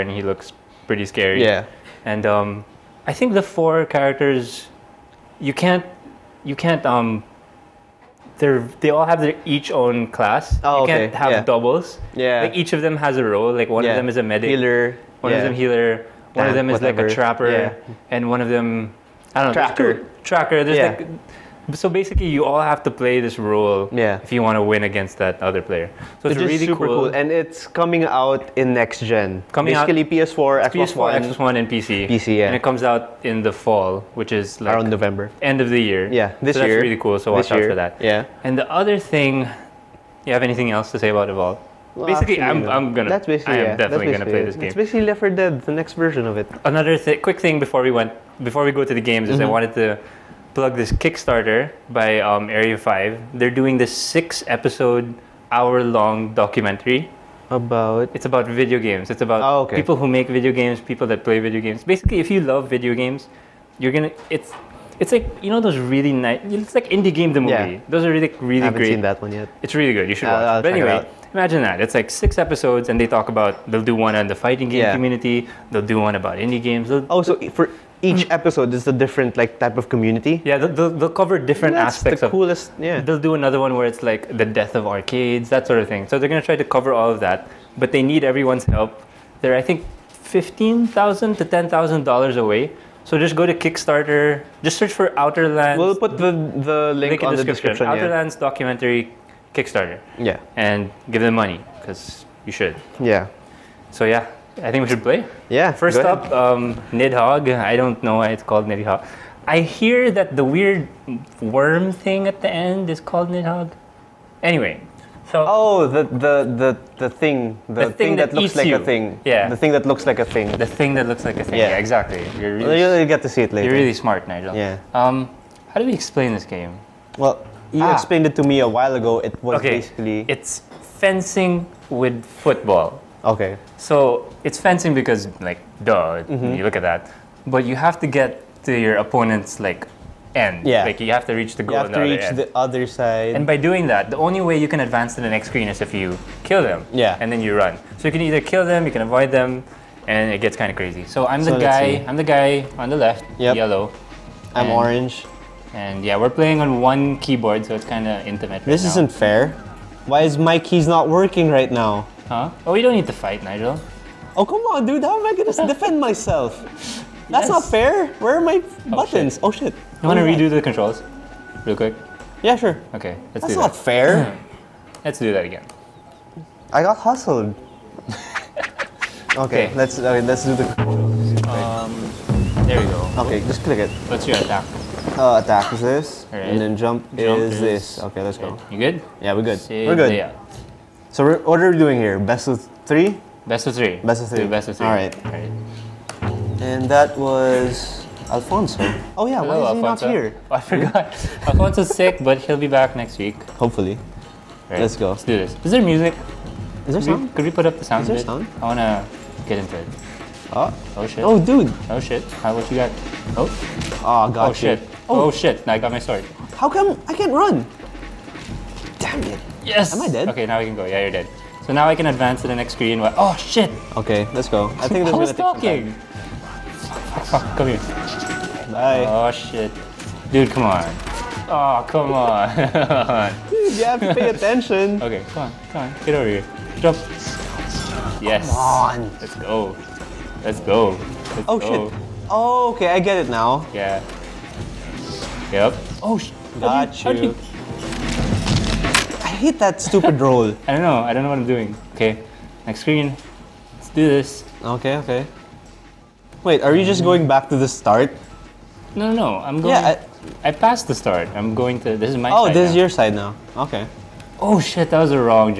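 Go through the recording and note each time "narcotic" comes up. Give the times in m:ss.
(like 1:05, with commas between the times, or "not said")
not said.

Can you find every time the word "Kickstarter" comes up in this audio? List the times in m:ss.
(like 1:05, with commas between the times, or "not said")
0:50, 1:33, 1:39.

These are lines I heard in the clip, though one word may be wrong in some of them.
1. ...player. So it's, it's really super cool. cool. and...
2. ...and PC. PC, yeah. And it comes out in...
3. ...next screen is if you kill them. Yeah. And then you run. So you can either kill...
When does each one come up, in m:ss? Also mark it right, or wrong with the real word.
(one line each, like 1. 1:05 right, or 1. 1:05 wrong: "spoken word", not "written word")
1. 0:25 right
2. 0:31 right
3. 2:25 right.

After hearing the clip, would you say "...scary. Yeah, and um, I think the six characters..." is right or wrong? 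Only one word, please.
wrong.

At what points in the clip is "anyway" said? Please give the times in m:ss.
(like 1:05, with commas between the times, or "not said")
1:10, 1:54.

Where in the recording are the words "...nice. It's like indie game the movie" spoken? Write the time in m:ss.
1:06.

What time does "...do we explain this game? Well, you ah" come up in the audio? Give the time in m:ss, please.
2:05.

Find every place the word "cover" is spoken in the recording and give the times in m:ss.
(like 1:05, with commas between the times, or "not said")
1:21, 1:26.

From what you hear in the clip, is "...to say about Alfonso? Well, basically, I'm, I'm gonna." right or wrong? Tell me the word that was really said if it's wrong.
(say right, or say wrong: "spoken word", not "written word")
wrong: "Evolve", not "Alfonso".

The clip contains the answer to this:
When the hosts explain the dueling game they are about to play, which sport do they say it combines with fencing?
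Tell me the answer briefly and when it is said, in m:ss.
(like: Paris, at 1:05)
Football, at 2:12.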